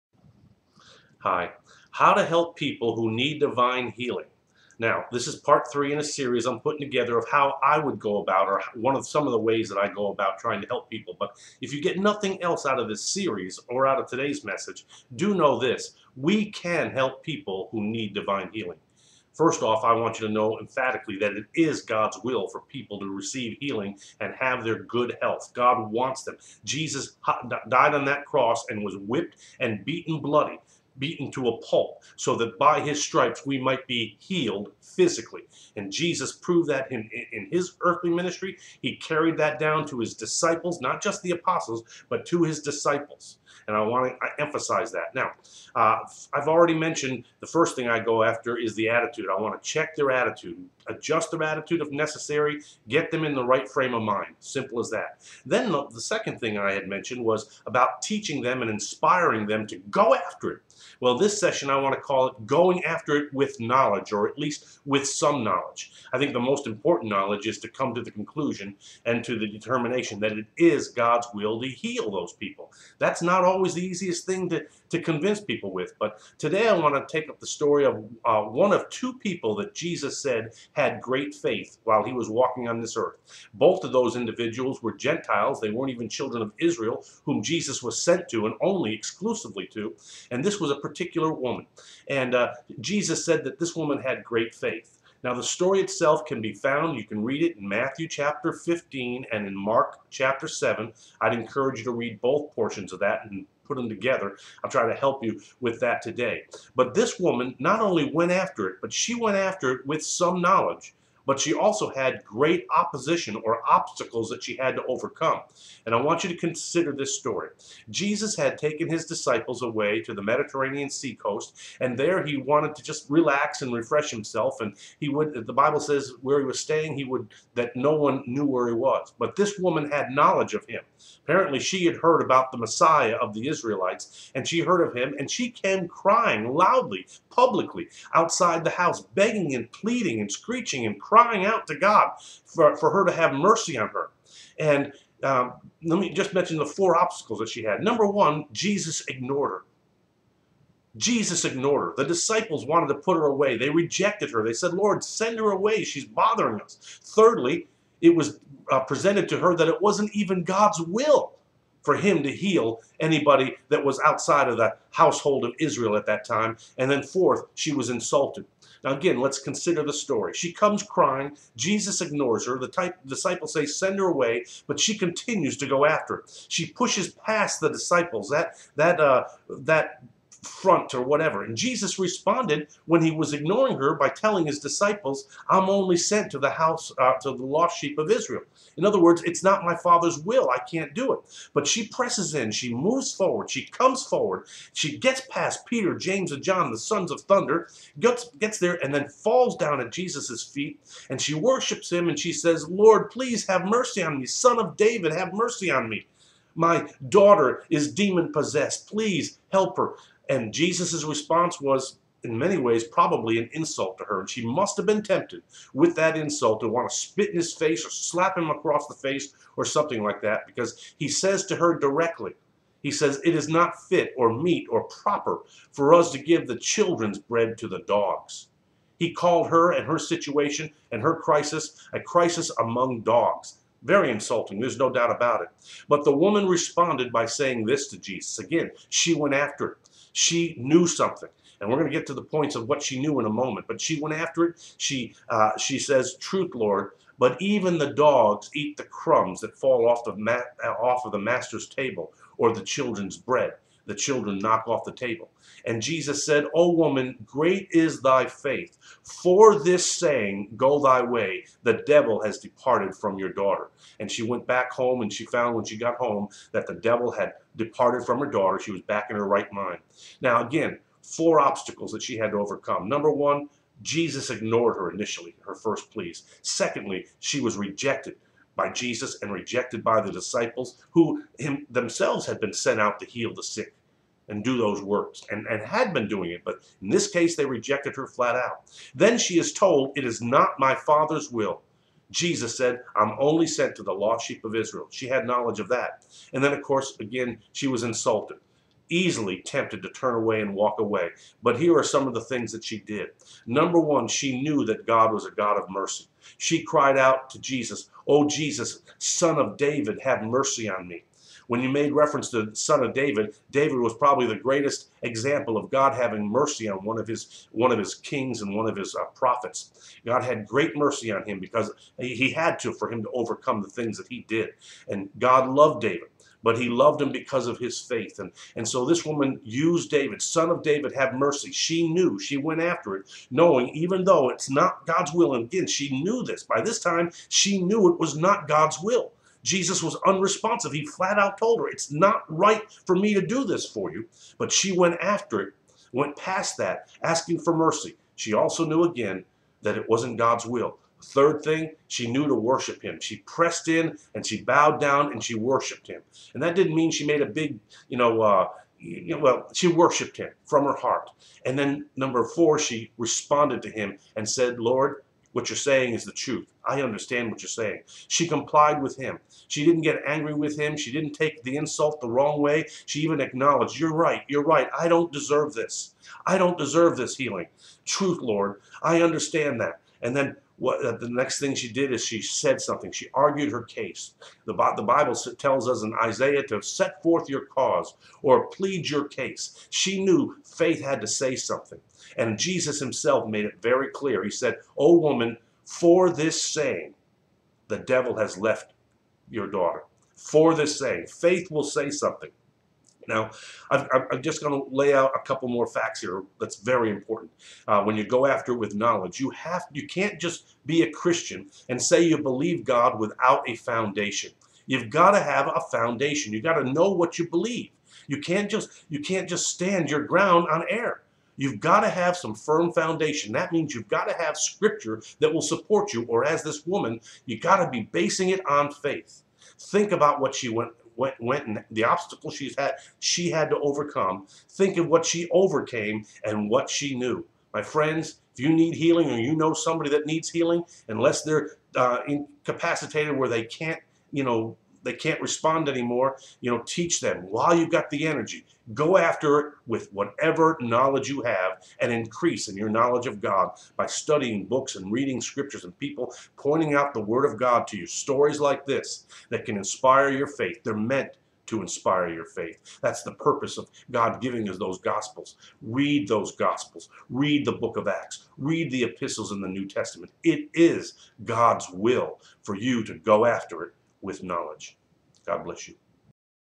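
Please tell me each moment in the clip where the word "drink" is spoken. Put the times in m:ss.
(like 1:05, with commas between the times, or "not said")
not said.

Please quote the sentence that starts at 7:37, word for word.
Stories like this that can inspire your faith.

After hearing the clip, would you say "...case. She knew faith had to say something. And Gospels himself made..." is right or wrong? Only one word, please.
wrong.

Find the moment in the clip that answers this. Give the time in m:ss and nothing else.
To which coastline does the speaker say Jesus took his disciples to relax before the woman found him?
2:00.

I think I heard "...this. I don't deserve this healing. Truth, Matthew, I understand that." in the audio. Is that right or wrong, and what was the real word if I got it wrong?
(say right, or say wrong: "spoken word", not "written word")
wrong: "Lord", not "Matthew".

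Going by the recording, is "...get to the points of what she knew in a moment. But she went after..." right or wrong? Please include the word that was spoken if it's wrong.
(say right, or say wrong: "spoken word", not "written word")
right.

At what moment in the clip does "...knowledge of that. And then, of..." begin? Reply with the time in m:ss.
4:55.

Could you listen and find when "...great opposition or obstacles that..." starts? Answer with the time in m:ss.
1:52.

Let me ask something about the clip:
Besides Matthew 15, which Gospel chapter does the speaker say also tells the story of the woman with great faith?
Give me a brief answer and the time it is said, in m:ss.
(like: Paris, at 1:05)
Mark chapter 7, at 1:39.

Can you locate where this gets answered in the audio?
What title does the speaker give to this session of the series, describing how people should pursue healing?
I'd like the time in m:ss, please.
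1:02.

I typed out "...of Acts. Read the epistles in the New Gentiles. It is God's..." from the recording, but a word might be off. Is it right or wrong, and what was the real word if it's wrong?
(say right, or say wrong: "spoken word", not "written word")
wrong: "Testament", not "Gentiles".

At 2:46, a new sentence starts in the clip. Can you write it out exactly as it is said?
And then fourth, she was insulted.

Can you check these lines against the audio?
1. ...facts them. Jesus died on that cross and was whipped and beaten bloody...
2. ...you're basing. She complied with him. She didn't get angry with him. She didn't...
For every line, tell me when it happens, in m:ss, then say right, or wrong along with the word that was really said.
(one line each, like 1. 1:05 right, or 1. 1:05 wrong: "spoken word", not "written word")
1. 0:25 wrong: "wants", not "facts"
2. 6:07 wrong: "saying", not "basing".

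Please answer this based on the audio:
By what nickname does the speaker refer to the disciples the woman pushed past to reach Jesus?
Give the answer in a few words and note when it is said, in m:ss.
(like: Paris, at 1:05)
Sons of thunder, at 3:16.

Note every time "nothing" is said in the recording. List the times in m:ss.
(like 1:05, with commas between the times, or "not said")
0:11.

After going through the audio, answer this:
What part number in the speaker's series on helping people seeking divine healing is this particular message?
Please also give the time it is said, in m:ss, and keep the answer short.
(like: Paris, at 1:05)
Part three, at 0:05.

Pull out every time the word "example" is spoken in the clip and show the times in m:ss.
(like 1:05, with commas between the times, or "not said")
5:15.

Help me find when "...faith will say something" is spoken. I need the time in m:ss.
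6:41.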